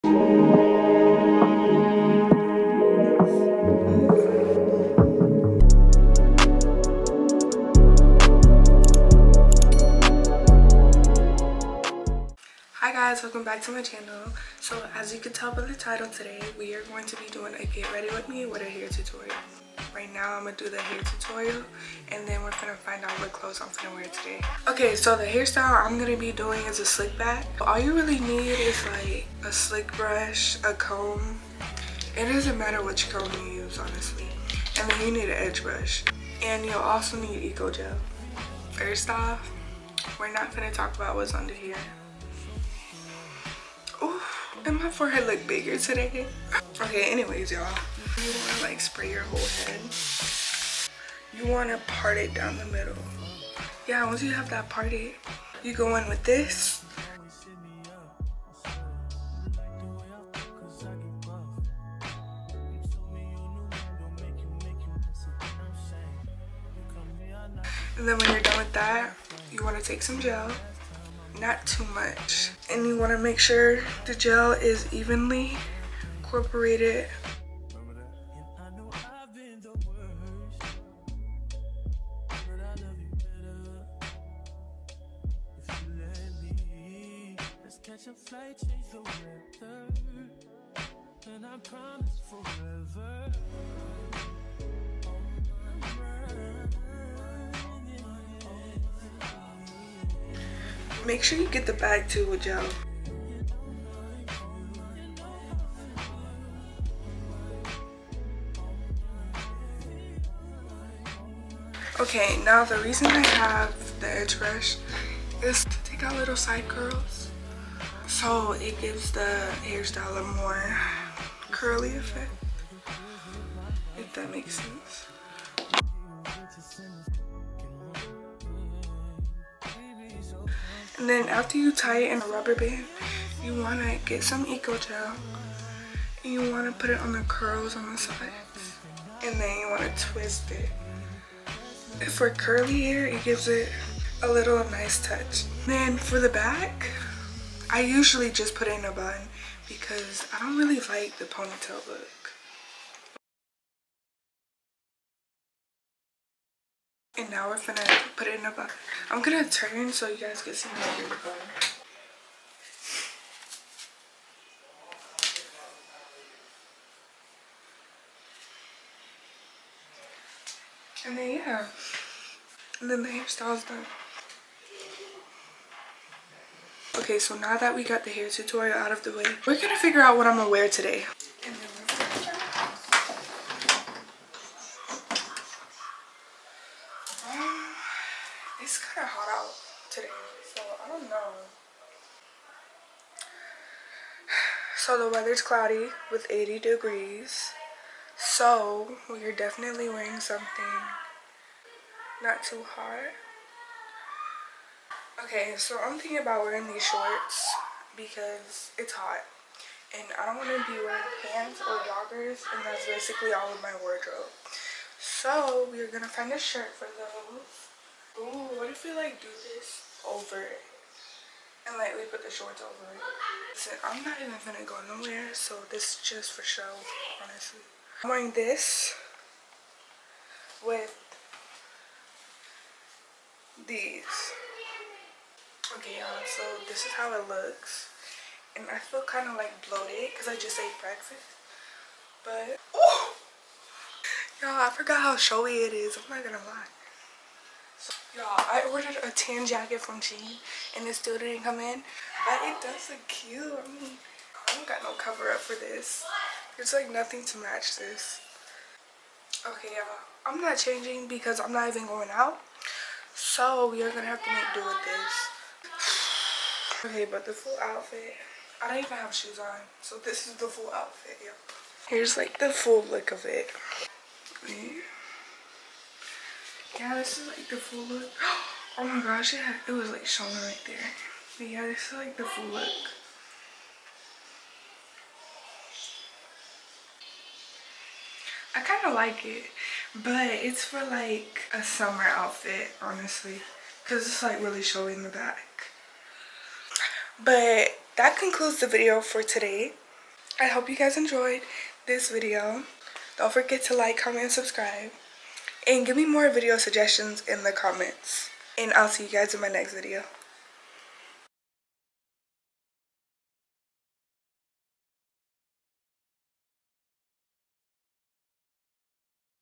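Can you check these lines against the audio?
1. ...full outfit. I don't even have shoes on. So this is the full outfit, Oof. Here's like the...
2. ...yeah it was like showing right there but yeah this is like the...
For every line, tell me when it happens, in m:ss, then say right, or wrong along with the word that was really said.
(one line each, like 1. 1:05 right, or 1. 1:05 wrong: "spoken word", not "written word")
1. 4:27 wrong: "Yep", not "Oof"
2. 4:39 right.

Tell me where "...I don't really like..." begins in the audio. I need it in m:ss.
2:30.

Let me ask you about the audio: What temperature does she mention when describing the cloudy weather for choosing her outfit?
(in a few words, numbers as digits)
80 degrees.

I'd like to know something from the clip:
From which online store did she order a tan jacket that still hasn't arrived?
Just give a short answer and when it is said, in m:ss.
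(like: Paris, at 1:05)
Shein, at 4:10.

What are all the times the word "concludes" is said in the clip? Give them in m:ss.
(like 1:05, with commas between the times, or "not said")
4:58.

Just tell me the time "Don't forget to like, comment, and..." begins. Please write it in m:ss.
5:03.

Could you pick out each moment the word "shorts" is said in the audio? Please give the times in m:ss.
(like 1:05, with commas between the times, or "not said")
3:26, 3:42.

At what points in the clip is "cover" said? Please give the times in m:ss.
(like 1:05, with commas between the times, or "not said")
4:14.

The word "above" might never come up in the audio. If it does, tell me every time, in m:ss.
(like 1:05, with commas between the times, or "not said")
not said.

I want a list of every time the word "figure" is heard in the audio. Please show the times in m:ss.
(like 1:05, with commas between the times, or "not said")
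2:59.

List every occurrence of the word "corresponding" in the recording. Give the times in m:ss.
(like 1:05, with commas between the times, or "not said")
not said.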